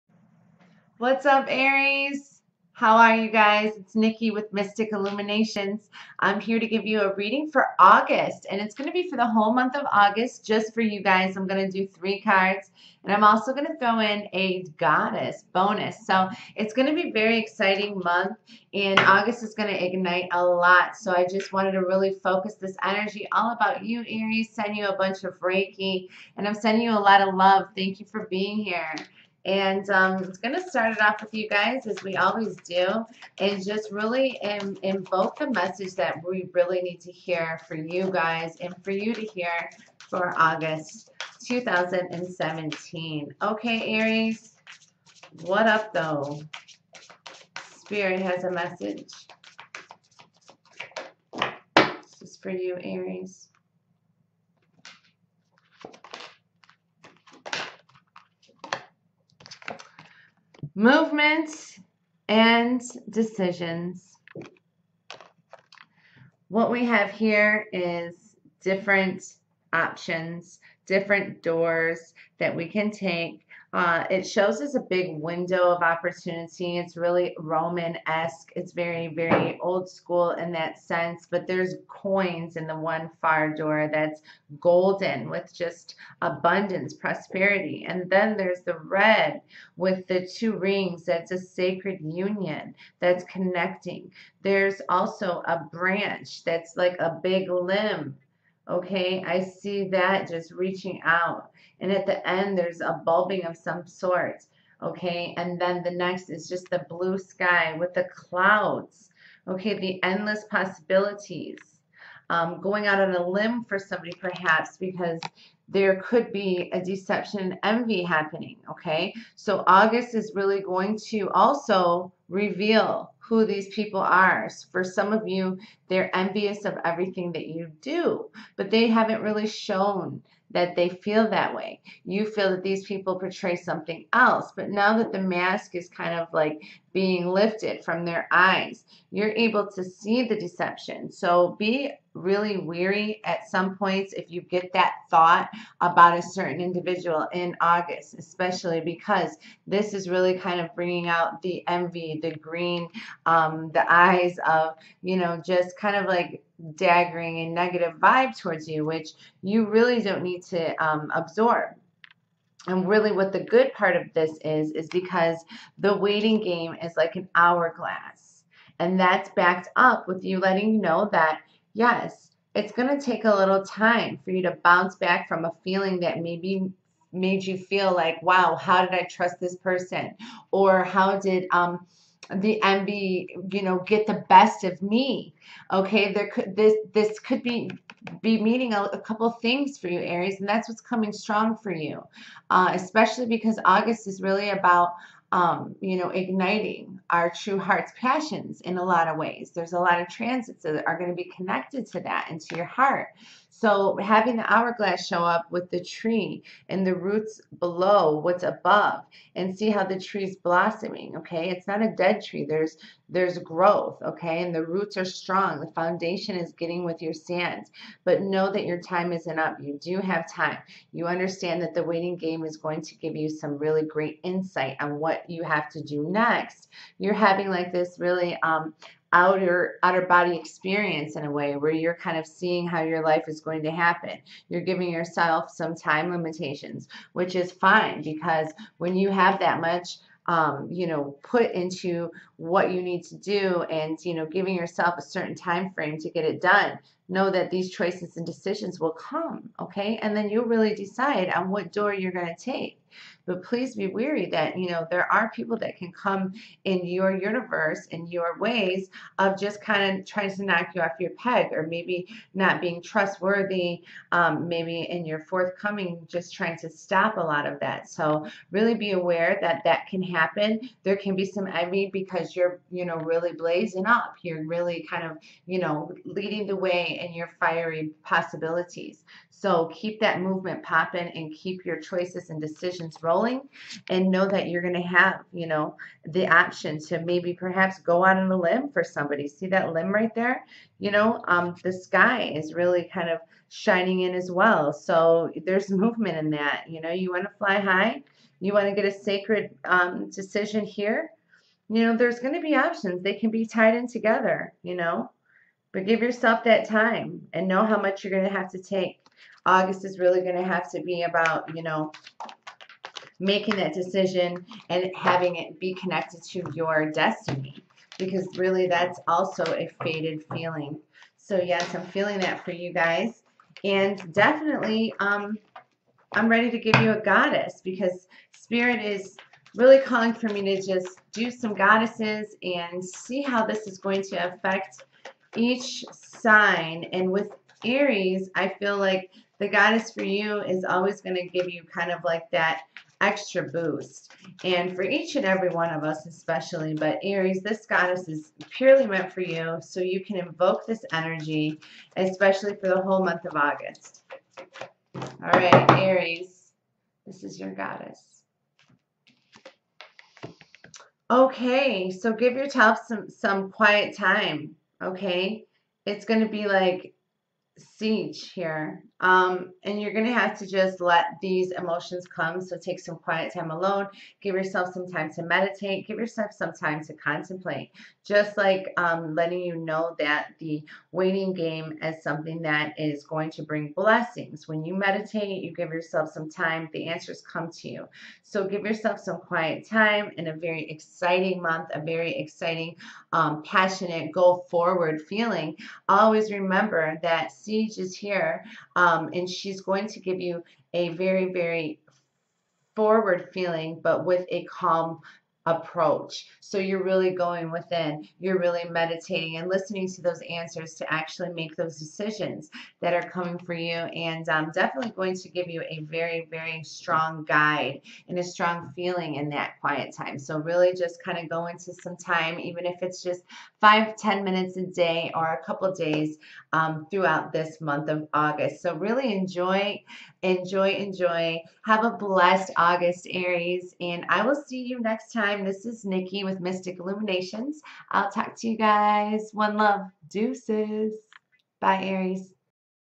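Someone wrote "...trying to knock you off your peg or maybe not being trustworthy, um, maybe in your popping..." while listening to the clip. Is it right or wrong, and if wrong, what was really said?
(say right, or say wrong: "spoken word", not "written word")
wrong: "forthcoming", not "popping".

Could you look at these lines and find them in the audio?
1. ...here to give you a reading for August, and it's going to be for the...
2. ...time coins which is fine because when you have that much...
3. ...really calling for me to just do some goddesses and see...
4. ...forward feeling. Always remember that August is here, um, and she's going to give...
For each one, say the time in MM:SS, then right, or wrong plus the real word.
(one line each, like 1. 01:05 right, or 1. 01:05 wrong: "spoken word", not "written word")
1. 00:06 right
2. 03:55 wrong: "limitations", not "coins"
3. 05:29 right
4. 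06:34 wrong: "Sige", not "August".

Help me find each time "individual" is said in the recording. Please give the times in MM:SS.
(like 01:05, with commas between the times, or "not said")
02:26.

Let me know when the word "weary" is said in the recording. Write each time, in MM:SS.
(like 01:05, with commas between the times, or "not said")
02:22, 04:13.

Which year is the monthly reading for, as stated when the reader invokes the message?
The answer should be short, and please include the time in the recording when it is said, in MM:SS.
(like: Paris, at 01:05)
2017, at 00:41.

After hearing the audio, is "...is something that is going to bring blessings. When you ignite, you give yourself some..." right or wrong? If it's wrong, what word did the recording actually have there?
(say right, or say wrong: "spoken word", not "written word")
wrong: "meditate", not "ignite".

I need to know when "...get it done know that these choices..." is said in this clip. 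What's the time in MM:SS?
04:06.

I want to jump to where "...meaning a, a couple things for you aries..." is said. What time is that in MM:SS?
03:08.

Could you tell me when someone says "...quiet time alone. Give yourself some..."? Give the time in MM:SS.
06:12.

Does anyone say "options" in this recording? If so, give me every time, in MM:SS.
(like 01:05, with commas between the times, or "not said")
01:09, 04:46, 05:02.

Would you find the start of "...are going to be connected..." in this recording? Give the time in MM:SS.
03:20.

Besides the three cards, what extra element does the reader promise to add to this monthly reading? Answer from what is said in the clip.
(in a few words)
goddess bonus.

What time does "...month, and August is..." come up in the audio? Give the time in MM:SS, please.
00:18.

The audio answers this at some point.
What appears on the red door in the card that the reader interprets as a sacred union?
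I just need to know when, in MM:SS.
01:30.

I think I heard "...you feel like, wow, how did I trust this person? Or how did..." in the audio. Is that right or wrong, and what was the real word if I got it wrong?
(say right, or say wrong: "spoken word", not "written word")
right.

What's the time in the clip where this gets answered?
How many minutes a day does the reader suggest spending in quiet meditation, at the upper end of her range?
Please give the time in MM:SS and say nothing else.
07:03.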